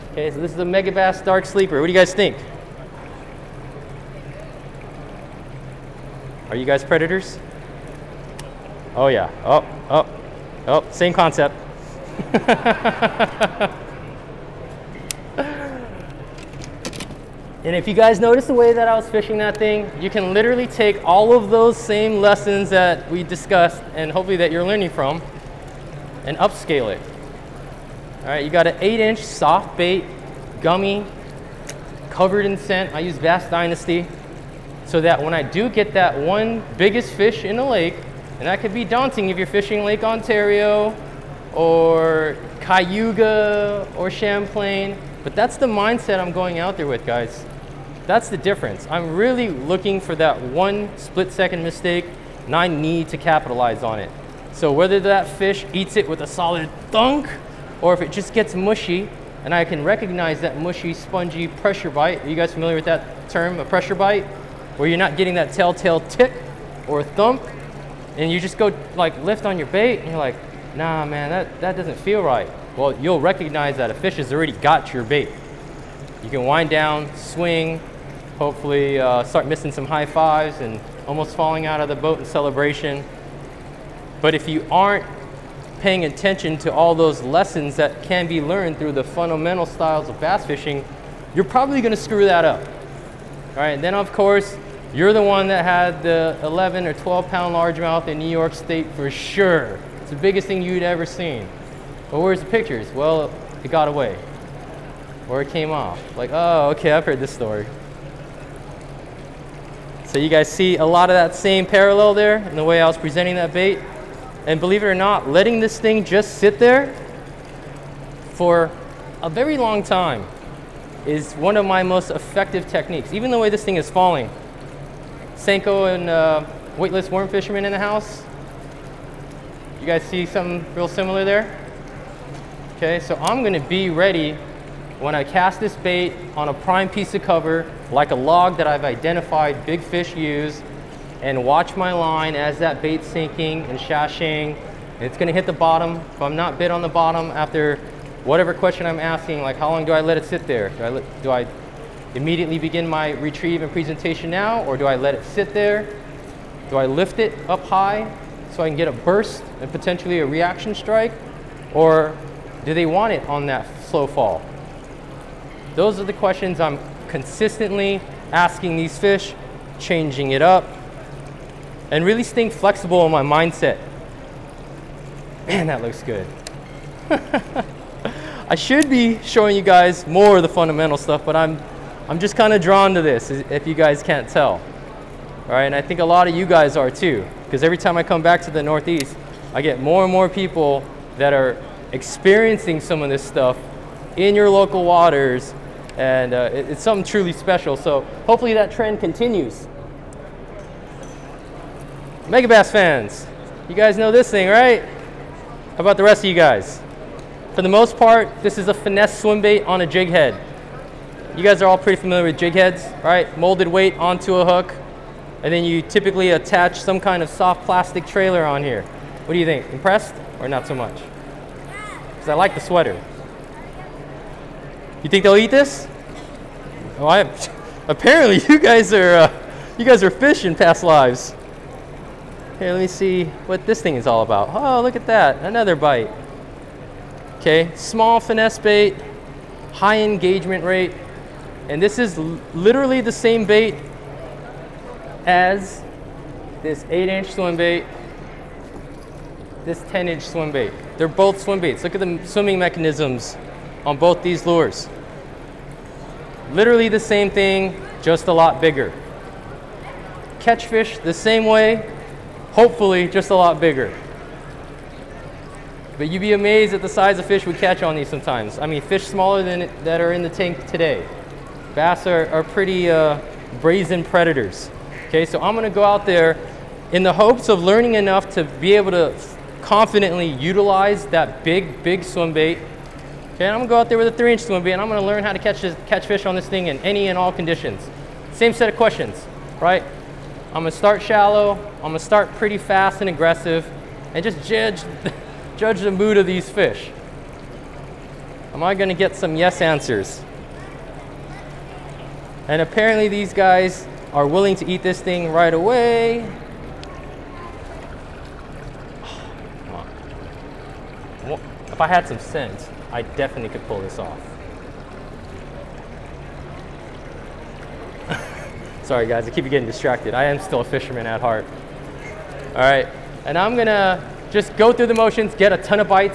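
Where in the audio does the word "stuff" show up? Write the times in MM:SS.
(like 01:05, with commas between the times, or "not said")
03:00, 03:13.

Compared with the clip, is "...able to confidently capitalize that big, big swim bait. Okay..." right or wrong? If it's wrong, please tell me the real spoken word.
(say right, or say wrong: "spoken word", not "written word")
wrong: "utilize", not "capitalize".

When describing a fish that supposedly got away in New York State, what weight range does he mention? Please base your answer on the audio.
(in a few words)
11 or 12 pounds.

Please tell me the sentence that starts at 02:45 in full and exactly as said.
Those are the questions I'm consistently asking these fish, changing it up, and really staying flexible in my mindset.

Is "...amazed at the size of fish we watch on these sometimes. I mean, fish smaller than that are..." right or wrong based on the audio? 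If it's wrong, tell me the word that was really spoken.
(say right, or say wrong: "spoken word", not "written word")
wrong: "catch", not "watch".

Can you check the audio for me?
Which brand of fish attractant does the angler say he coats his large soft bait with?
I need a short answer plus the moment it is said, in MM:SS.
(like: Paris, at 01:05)
Bass Dynasty, at 00:33.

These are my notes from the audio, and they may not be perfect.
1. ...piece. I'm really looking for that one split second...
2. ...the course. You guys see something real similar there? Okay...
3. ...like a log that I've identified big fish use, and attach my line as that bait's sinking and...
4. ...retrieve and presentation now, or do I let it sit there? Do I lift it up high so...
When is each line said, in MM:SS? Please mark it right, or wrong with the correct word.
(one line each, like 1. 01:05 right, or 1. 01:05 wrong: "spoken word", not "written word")
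1. 00:48 wrong: "difference", not "piece"
2. 02:07 wrong: "house", not "course"
3. 02:17 wrong: "watch", not "attach"
4. 02:33 right.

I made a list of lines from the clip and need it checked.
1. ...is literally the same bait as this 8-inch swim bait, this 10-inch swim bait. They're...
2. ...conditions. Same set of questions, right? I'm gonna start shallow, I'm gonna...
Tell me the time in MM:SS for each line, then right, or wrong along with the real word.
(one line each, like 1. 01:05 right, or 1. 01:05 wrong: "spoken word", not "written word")
1. 04:01 right
2. 04:47 right.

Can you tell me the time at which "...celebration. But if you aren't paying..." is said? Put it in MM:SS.
01:22.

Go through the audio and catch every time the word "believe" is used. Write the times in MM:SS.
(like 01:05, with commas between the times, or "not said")
01:54.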